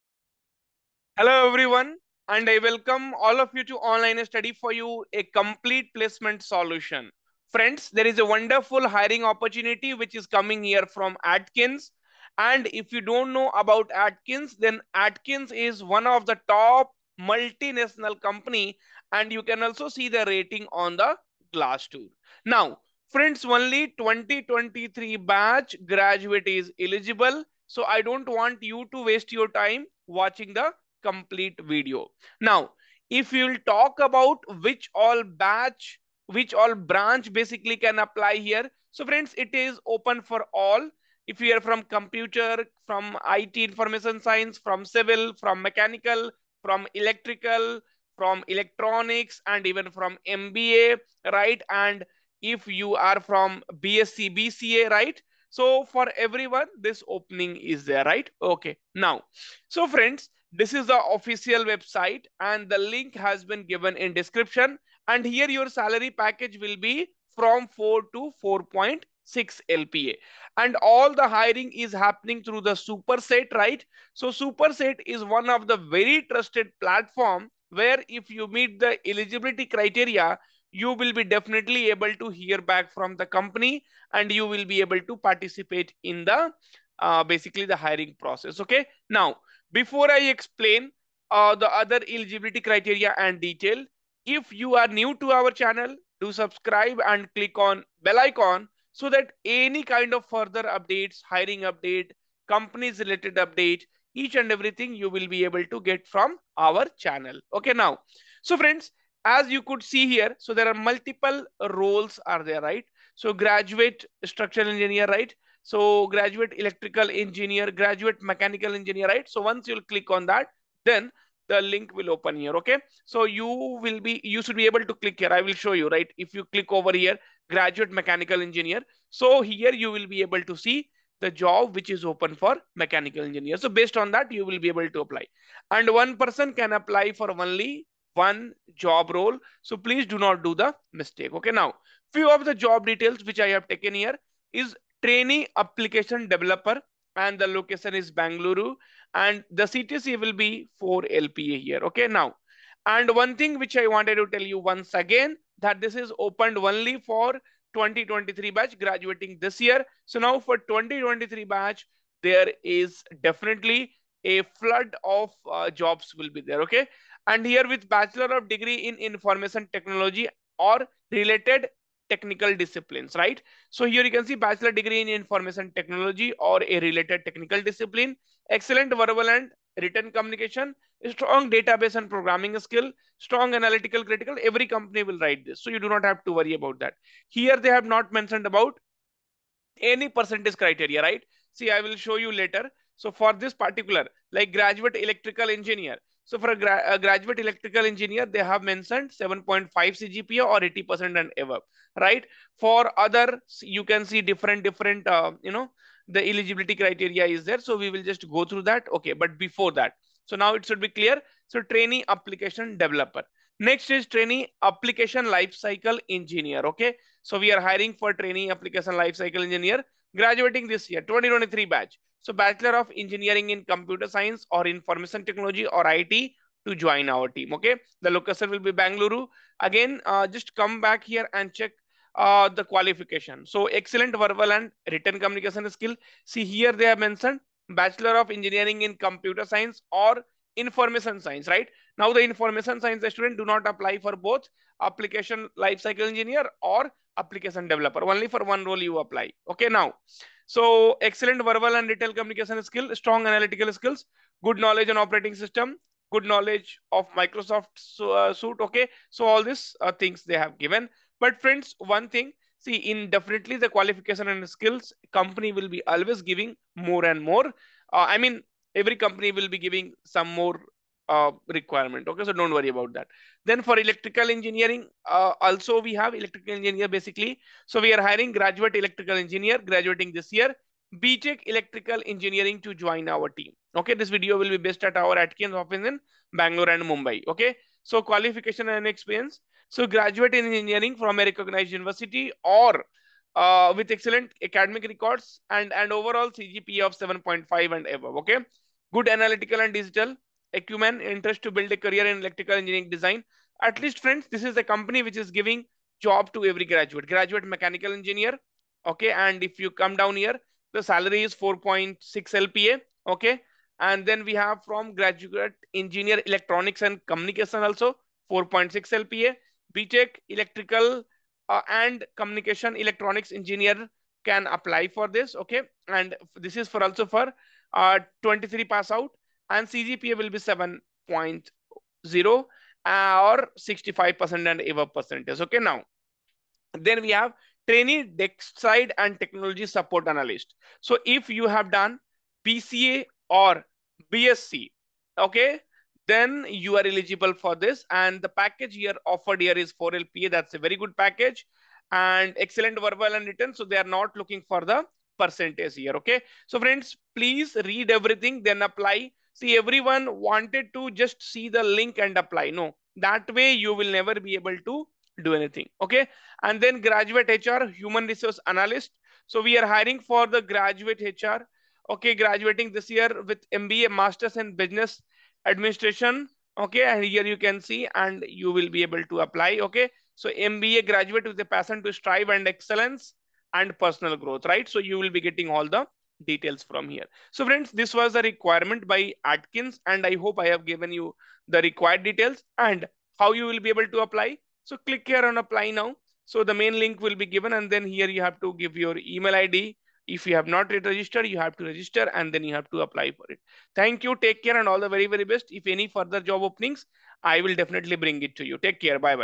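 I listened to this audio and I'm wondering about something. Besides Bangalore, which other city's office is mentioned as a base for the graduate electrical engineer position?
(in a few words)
Mumbai.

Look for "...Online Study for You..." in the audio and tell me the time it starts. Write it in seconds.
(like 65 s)
3 s.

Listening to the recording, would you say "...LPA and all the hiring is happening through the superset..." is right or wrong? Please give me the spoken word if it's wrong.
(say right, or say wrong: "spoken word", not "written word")
right.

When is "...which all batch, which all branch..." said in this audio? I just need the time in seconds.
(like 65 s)
34 s.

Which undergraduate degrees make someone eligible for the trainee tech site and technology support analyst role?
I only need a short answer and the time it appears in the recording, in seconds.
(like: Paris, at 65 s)
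BCA or BSc, at 342 s.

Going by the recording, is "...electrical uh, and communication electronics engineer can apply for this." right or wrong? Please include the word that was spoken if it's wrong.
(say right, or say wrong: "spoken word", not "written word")
right.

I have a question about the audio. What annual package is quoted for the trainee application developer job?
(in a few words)
4 LPA.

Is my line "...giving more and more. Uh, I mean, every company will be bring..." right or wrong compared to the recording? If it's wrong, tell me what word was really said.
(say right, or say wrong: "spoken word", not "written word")
wrong: "giving", not "bring".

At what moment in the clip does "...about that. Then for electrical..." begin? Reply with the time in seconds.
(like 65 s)
272 s.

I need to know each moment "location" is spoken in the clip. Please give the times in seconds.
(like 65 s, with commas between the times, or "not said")
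147 s, 228 s.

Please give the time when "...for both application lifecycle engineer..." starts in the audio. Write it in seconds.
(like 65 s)
243 s.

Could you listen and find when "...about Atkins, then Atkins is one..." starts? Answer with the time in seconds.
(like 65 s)
13 s.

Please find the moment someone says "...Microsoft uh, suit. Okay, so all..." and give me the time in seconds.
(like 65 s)
257 s.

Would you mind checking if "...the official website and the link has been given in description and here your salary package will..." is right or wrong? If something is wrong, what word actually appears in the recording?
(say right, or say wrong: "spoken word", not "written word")
right.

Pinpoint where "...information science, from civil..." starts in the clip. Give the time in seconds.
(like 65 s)
43 s.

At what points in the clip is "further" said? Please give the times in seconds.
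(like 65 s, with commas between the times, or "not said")
100 s, 405 s.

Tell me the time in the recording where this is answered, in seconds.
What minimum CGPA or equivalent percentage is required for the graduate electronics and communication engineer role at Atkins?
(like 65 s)
330 s.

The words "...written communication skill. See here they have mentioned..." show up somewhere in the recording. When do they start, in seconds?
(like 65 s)
234 s.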